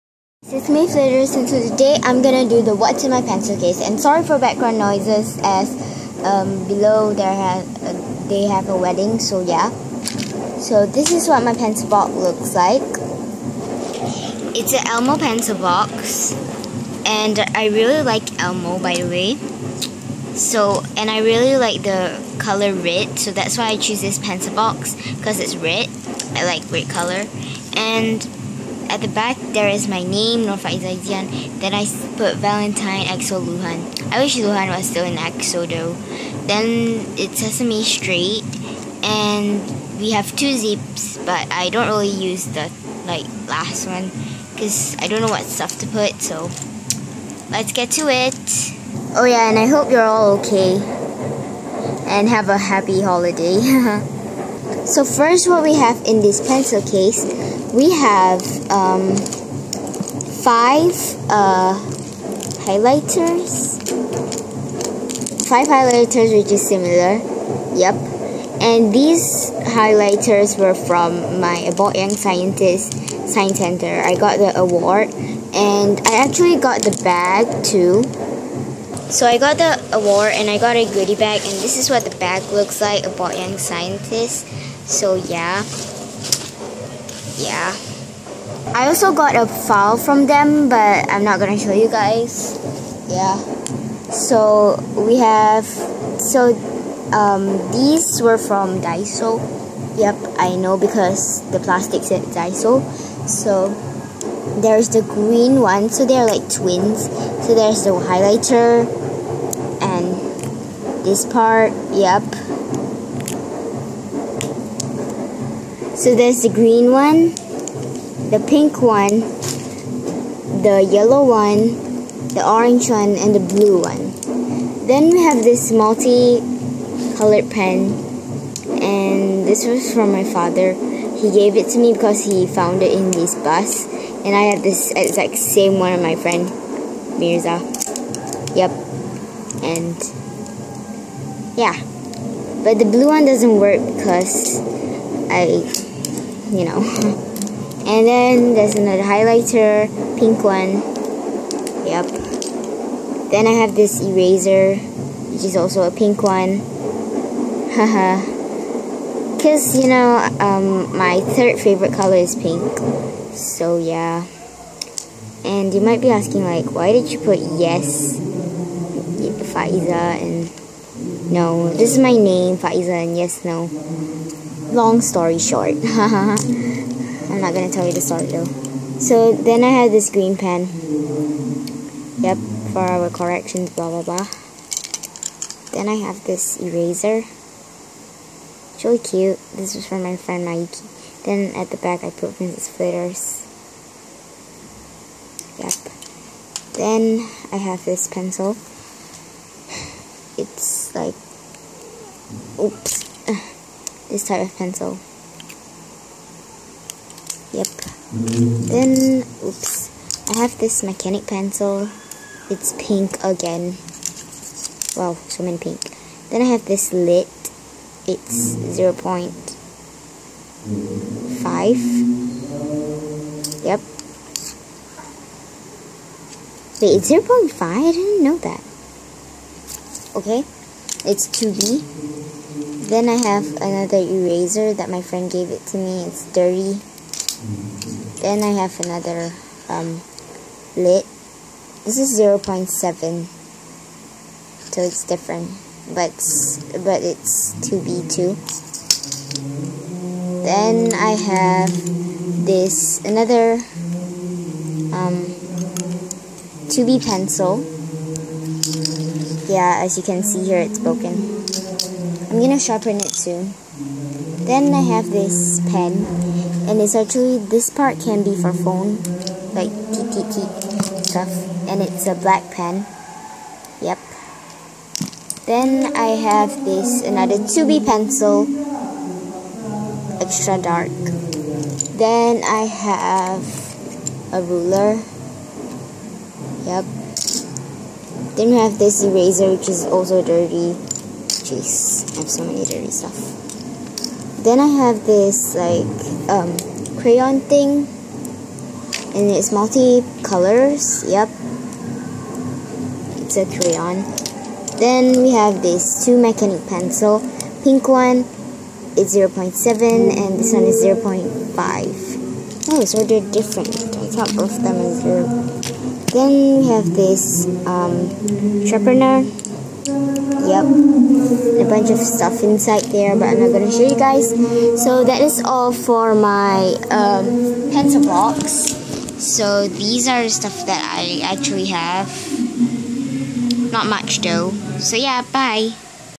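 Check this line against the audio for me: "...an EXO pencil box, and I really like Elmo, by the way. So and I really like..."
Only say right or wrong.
wrong.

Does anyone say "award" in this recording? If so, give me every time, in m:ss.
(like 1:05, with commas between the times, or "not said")
1:14, 1:19.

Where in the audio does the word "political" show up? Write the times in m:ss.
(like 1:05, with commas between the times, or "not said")
not said.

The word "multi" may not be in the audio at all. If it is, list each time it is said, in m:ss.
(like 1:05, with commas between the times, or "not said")
2:05, 4:59.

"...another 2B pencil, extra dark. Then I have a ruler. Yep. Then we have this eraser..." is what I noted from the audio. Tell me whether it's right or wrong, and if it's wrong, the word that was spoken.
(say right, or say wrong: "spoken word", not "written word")
right.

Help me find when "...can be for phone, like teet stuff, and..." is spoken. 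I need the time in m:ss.
4:27.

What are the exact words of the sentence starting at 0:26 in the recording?
I like red color, and at the back, there is my name, Norfa Izaidian.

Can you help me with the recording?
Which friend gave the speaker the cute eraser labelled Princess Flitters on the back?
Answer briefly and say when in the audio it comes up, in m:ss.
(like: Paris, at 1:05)
Mikey, at 3:10.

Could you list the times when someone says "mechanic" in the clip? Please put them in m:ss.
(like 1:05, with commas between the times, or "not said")
3:30, 5:06.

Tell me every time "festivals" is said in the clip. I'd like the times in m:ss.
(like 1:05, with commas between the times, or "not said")
not said.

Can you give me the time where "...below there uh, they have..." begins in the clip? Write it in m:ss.
0:06.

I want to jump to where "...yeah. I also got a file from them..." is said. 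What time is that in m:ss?
1:27.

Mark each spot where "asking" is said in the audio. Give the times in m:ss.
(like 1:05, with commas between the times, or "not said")
2:46.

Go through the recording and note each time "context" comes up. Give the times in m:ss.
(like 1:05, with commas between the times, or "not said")
not said.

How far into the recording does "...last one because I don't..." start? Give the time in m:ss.
0:43.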